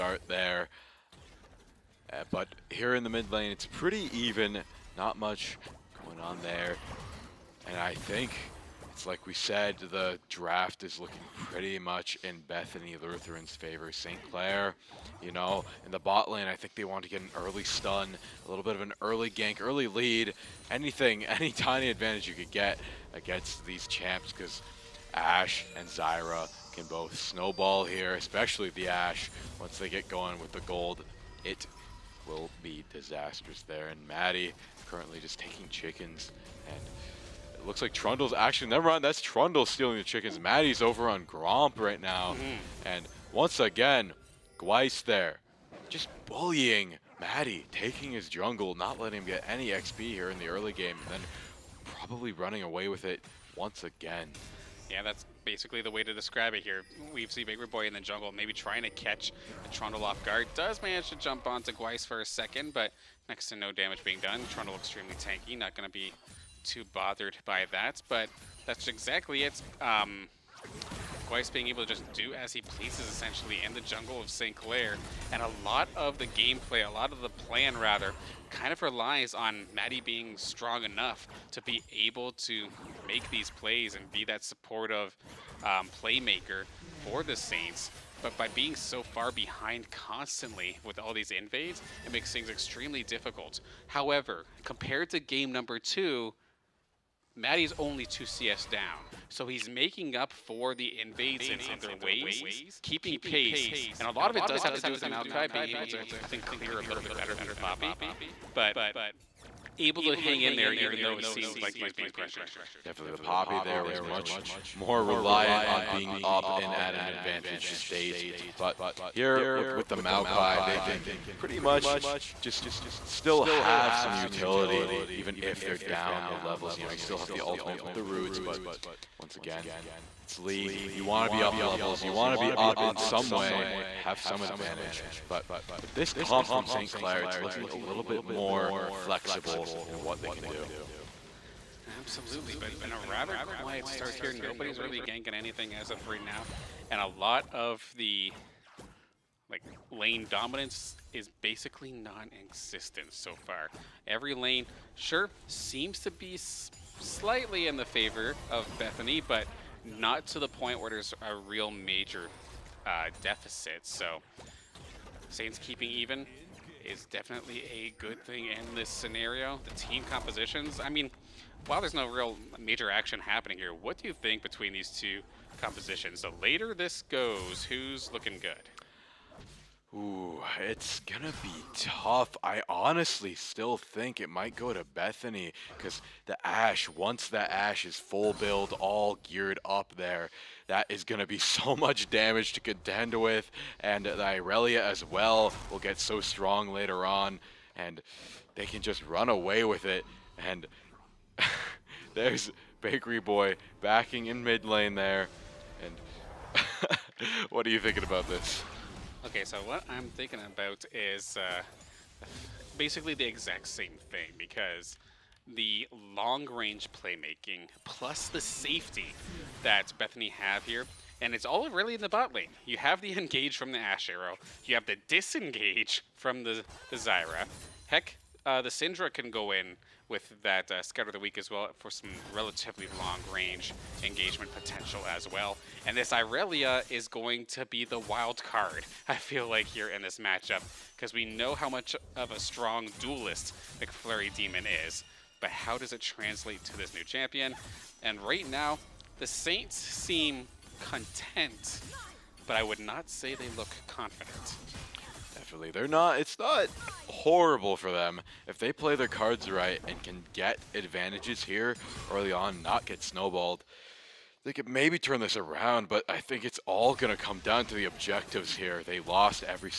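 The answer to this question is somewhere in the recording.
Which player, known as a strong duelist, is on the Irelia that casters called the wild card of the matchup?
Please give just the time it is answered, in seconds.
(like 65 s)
243 s.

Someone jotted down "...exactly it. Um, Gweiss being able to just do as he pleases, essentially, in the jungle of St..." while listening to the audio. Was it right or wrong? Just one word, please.
right.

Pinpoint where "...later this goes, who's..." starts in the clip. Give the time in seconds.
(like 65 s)
176 s.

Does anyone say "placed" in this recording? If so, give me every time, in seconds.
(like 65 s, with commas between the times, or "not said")
not said.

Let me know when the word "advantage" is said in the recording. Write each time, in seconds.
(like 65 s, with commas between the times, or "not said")
21 s, 117 s, 134 s, 260 s.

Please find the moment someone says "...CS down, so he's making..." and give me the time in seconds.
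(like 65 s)
98 s.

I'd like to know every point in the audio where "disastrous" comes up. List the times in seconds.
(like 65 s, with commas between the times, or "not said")
32 s.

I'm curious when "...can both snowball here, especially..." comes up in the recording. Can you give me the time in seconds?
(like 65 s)
26 s.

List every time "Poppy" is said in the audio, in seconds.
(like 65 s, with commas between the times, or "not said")
107 s, 113 s.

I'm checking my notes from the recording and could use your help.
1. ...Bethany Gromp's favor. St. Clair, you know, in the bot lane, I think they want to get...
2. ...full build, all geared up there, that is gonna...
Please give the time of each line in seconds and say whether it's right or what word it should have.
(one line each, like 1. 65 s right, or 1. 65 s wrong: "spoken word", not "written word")
1. 12 s wrong: "Lutheran", not "Gromp"
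2. 187 s right.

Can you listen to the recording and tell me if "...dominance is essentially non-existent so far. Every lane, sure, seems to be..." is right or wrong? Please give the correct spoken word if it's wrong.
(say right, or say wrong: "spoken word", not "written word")
wrong: "basically", not "essentially".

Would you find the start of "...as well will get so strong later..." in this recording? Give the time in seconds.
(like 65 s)
194 s.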